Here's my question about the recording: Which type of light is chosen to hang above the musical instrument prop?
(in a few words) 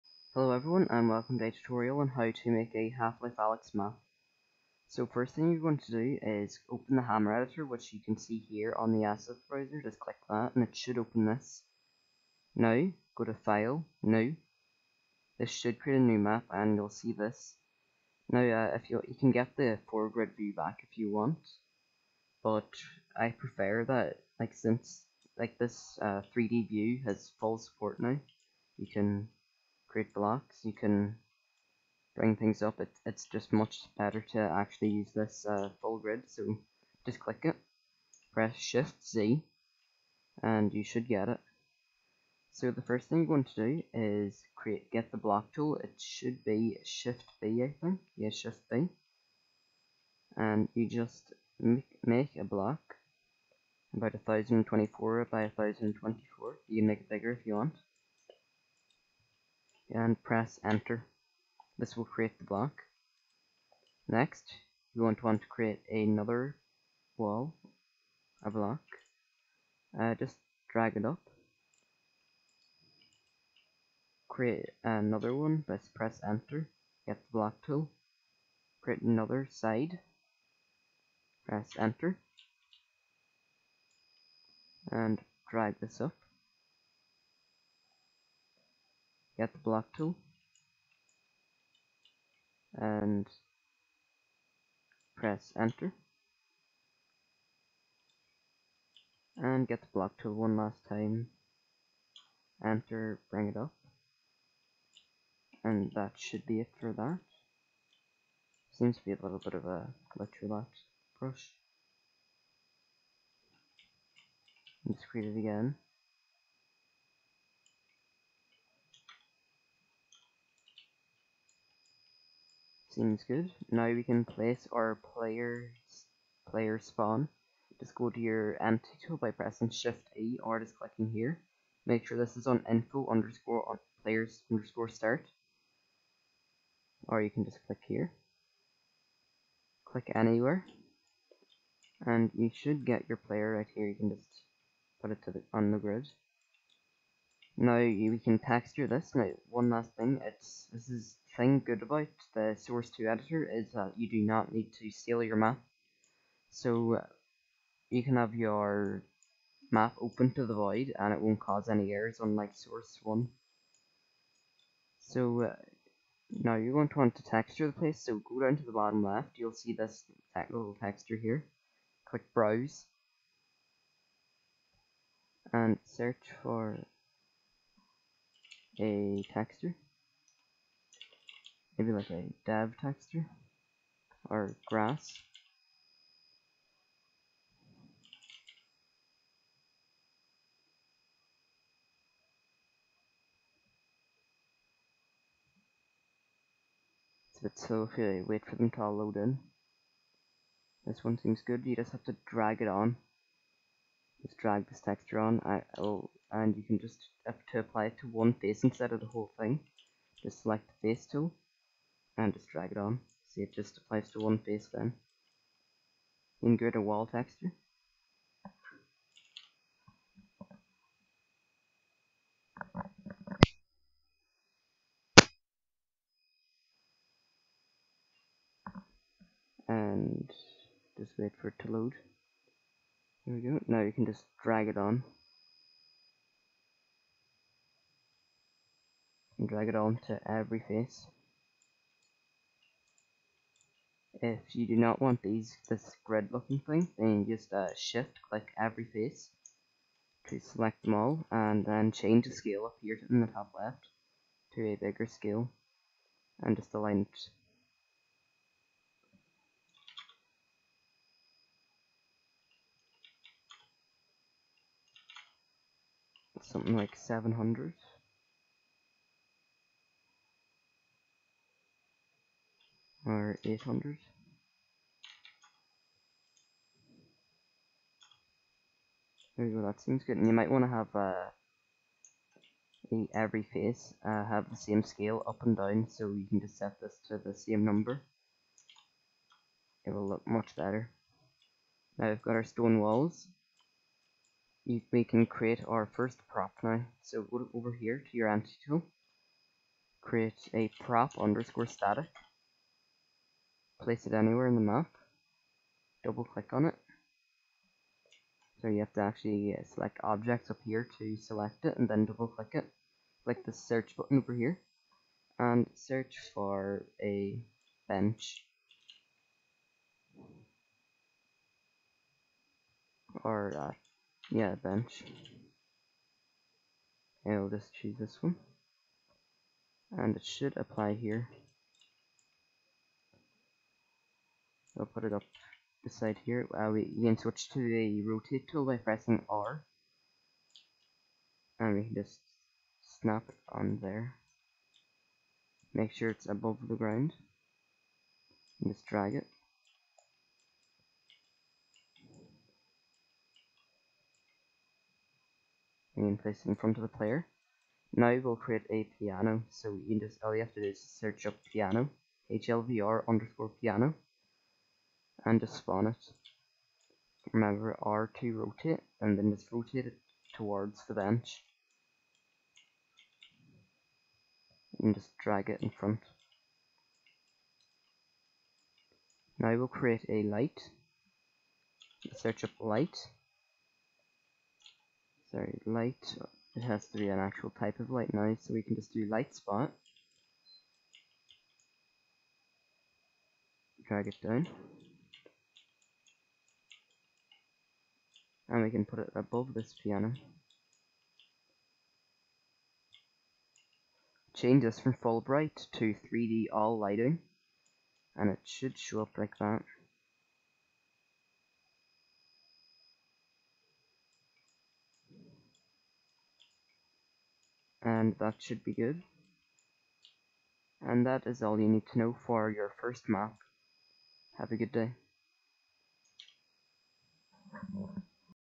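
light spot.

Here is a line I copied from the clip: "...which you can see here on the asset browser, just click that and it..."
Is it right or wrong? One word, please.
right.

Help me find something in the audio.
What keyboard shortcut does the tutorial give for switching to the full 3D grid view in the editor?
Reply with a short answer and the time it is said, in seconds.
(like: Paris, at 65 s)
Shift Z, at 38 s.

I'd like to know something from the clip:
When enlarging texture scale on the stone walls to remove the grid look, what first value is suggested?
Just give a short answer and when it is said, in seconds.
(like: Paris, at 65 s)
700, at 266 s.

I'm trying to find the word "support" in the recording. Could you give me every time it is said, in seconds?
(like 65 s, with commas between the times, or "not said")
27 s.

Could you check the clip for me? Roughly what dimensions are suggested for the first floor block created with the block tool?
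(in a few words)
1024 by 1024.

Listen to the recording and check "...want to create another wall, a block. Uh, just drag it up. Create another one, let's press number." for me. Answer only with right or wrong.
wrong.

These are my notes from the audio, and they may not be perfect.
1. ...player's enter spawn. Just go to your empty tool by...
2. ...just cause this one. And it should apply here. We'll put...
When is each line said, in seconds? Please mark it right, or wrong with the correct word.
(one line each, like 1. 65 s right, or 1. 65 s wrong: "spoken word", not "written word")
1. 125 s wrong: "player", not "enter"
2. 327 s wrong: "choose", not "cause".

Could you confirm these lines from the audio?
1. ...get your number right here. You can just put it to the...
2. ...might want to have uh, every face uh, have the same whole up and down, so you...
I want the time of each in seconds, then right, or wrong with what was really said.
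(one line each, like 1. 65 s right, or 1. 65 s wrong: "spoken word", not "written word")
1. 142 s wrong: "player", not "number"
2. 280 s wrong: "scale", not "whole".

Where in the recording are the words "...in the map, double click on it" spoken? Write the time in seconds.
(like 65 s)
304 s.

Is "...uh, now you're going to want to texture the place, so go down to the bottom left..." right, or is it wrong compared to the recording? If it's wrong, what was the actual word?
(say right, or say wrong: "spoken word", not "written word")
right.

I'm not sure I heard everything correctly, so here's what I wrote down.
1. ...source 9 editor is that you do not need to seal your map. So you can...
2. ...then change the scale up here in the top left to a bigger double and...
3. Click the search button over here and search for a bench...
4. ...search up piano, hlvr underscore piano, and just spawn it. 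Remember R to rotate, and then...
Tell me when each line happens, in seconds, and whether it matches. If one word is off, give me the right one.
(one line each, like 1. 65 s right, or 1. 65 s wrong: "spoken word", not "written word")
1. 152 s wrong: "2", not "9"
2. 251 s wrong: "scale", not "double"
3. 313 s right
4. 360 s right.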